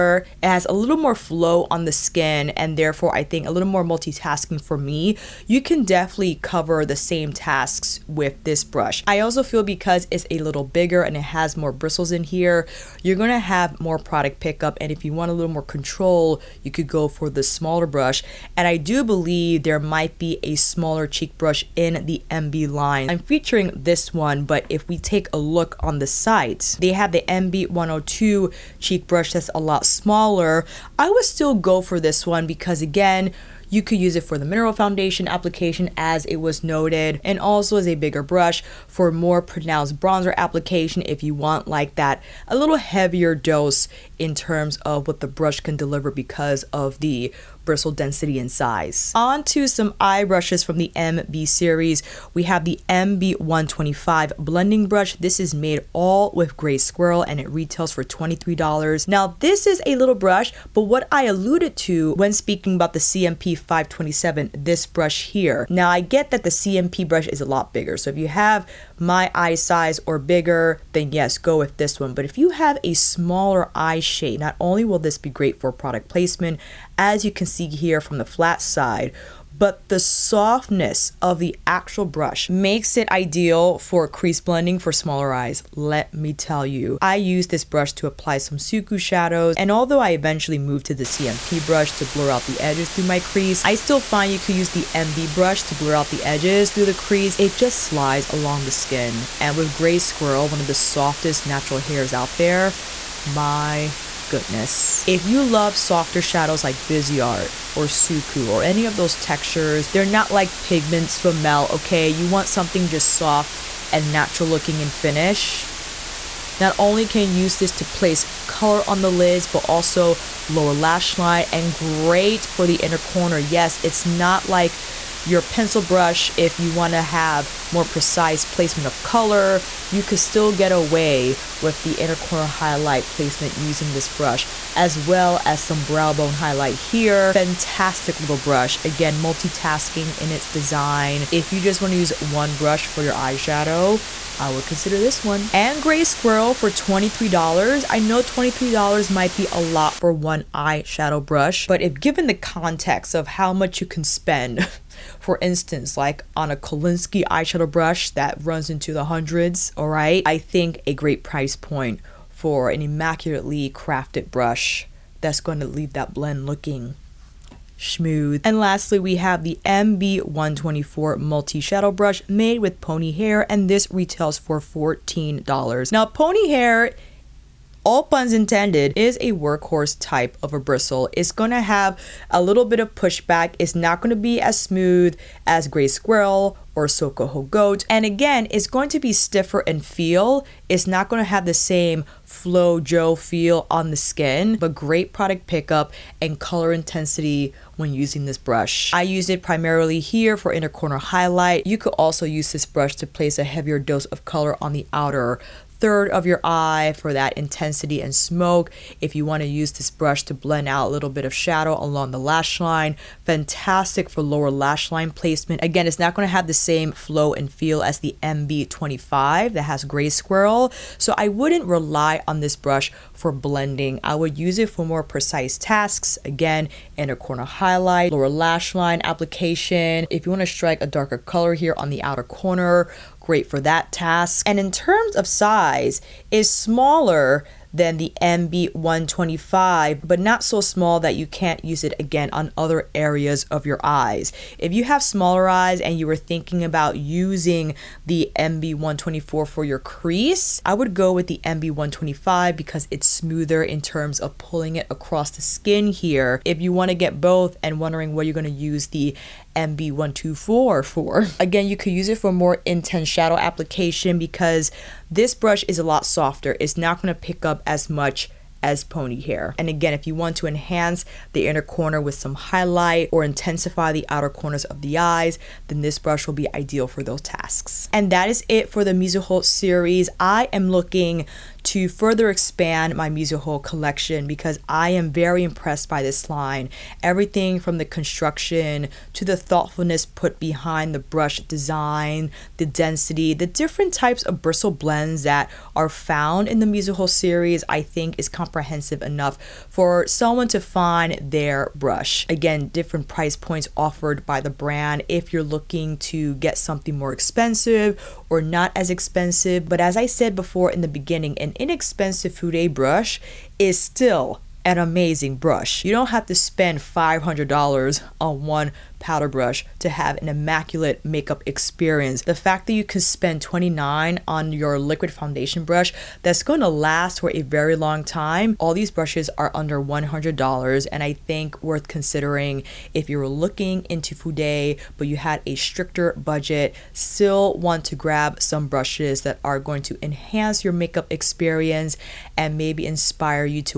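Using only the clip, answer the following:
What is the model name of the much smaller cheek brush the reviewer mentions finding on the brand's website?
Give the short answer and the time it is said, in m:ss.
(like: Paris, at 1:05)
MB102, at 0:27.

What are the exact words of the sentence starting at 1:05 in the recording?
Now I get that the CMP brush is a lot bigger.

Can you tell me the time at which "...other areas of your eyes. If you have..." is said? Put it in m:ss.
4:02.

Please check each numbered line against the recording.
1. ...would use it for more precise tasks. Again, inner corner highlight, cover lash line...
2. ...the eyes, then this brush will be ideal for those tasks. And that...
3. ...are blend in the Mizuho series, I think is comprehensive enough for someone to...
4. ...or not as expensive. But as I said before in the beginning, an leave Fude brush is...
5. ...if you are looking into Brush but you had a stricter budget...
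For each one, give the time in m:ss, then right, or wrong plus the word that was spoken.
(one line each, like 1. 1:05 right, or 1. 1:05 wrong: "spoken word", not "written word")
1. 3:44 wrong: "lower", not "cover"
2. 4:34 right
3. 4:55 wrong: "found", not "blend"
4. 5:08 wrong: "inexpensive", not "leave"
5. 5:32 wrong: "Fude", not "Brush".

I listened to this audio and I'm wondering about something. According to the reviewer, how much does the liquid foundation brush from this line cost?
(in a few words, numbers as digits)
29.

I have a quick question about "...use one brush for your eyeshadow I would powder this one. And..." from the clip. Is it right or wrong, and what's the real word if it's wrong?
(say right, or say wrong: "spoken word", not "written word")
wrong: "consider", not "powder".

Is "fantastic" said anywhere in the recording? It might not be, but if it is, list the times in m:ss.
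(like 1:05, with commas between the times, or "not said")
2:17, 3:33.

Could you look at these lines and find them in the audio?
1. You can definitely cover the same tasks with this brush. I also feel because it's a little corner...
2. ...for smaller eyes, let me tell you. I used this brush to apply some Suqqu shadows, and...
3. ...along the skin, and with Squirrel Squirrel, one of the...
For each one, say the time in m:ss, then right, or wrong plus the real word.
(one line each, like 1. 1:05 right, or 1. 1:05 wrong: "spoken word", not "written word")
1. 0:05 wrong: "bigger", not "corner"
2. 1:24 right
3. 1:38 wrong: "Gray", not "Squirrel".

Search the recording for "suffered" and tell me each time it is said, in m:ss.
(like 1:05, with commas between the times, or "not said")
not said.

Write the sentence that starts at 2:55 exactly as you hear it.
Now, pony hair all puns intended, is a workhorse type of a bristle.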